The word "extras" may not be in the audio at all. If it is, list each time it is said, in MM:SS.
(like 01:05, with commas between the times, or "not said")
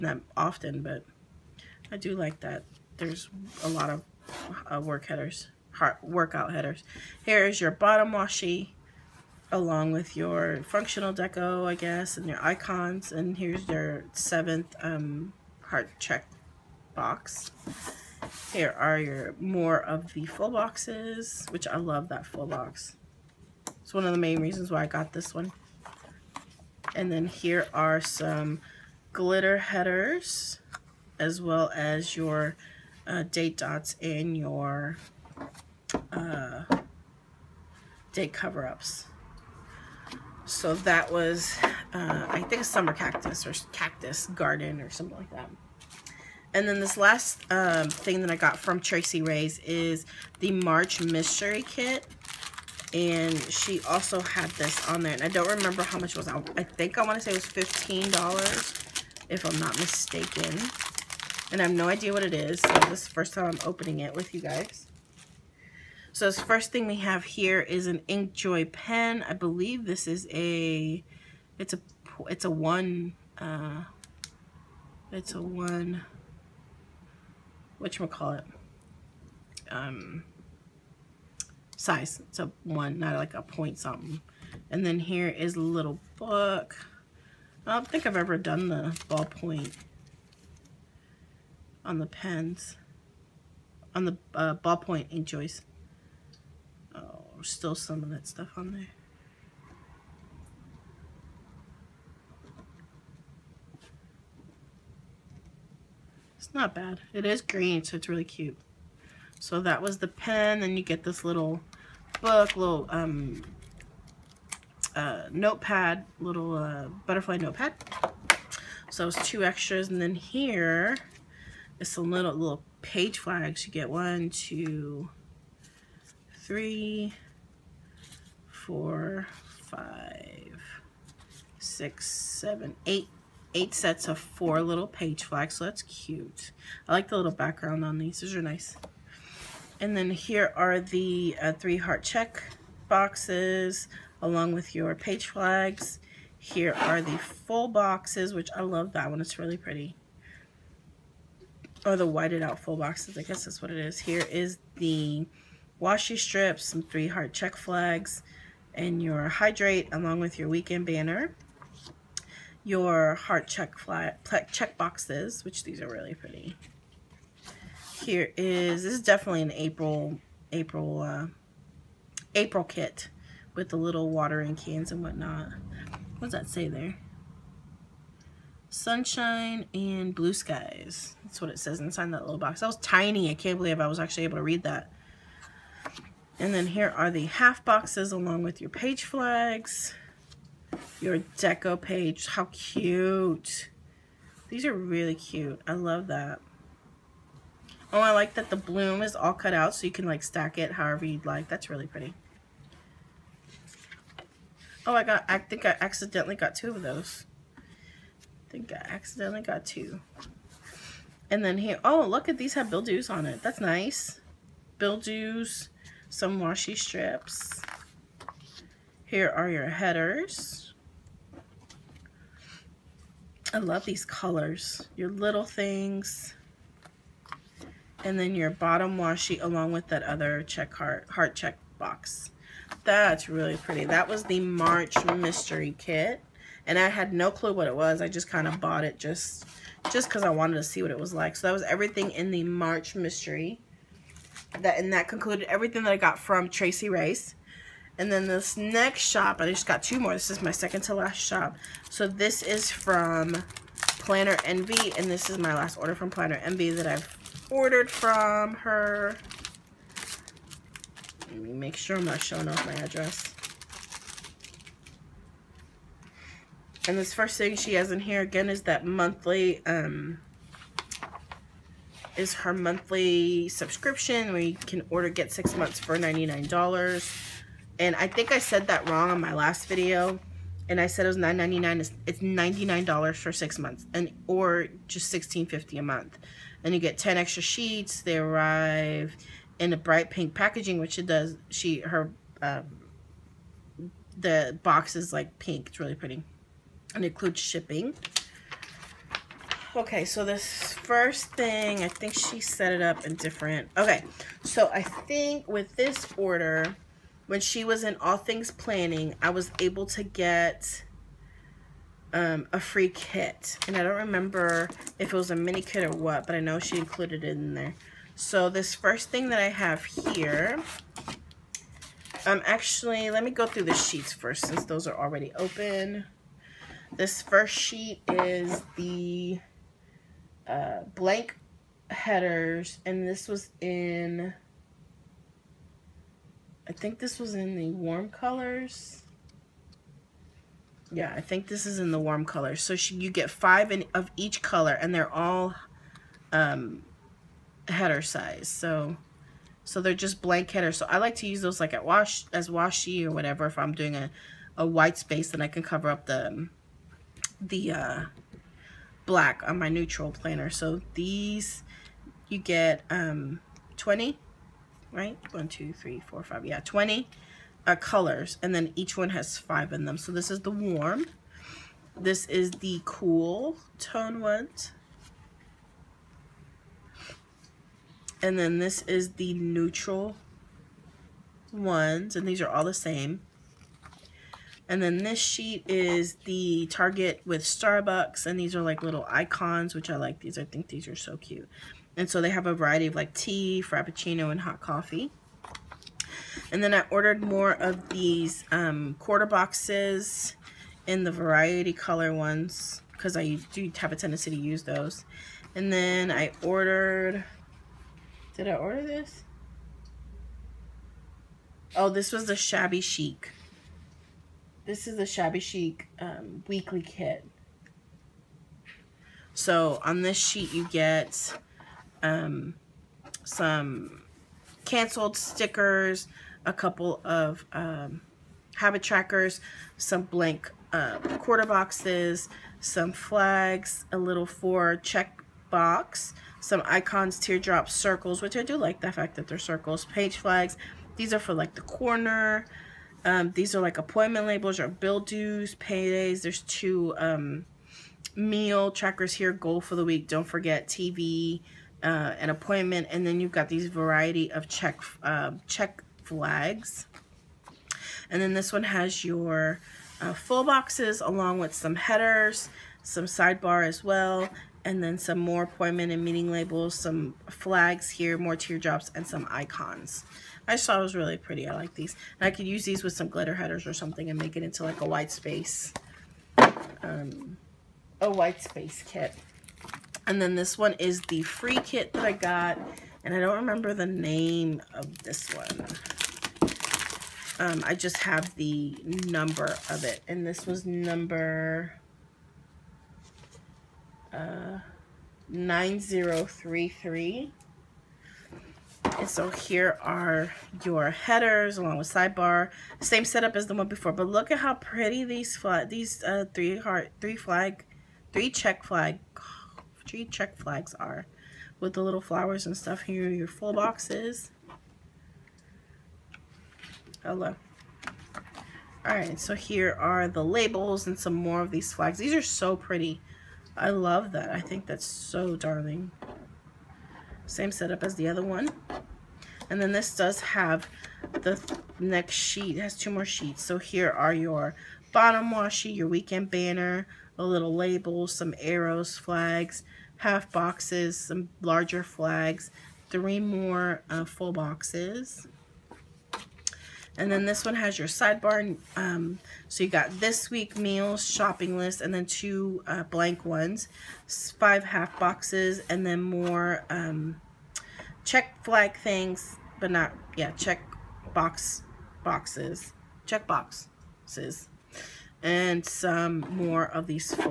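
01:59, 04:47.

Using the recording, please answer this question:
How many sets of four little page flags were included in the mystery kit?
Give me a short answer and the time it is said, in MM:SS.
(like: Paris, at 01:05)
8, at 02:13.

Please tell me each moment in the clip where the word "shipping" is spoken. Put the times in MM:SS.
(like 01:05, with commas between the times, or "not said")
04:57.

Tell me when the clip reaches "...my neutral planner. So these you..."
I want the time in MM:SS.
05:59.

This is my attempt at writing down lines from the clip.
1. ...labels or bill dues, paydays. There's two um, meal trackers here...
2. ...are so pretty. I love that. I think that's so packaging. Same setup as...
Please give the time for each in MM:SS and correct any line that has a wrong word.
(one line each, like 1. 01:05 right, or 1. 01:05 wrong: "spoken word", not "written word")
1. 07:24 right
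2. 08:42 wrong: "darling", not "packaging".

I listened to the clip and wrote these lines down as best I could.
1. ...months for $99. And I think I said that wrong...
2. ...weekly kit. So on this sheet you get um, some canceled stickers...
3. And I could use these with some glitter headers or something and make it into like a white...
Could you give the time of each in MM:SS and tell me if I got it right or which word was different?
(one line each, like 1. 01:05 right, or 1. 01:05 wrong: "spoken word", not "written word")
1. 04:35 right
2. 06:56 right
3. 07:52 right.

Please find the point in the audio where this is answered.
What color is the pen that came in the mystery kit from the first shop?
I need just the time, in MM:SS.
01:47.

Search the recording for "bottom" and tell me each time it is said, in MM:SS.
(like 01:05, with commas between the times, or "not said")
00:07, 03:48, 08:54.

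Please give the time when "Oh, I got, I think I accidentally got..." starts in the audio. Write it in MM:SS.
03:24.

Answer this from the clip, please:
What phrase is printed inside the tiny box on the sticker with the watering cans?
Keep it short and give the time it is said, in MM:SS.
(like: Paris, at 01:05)
Sunshine and blue skies, at 02:58.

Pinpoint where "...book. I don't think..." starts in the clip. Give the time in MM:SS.
01:26.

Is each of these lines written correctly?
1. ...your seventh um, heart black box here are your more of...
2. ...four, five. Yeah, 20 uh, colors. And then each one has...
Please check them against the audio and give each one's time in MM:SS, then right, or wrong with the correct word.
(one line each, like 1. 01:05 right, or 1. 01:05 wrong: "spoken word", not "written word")
1. 00:13 wrong: "check", not "black"
2. 06:06 right.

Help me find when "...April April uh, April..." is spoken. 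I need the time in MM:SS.
02:49.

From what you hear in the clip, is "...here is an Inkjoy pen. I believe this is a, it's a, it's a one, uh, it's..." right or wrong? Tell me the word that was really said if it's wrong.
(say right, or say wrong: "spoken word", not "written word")
right.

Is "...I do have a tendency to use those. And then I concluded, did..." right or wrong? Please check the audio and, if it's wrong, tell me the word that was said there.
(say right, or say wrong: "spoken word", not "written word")
wrong: "ordered", not "concluded".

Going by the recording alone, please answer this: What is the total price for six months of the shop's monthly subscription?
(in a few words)
$99.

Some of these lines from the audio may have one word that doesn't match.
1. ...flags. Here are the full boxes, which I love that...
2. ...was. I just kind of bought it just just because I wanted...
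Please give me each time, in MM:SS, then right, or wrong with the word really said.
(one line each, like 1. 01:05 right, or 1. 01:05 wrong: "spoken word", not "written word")
1. 02:25 right
2. 03:57 right.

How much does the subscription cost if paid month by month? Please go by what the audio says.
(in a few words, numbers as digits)
$16.50.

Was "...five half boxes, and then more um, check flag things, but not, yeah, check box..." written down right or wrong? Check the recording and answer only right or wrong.
right.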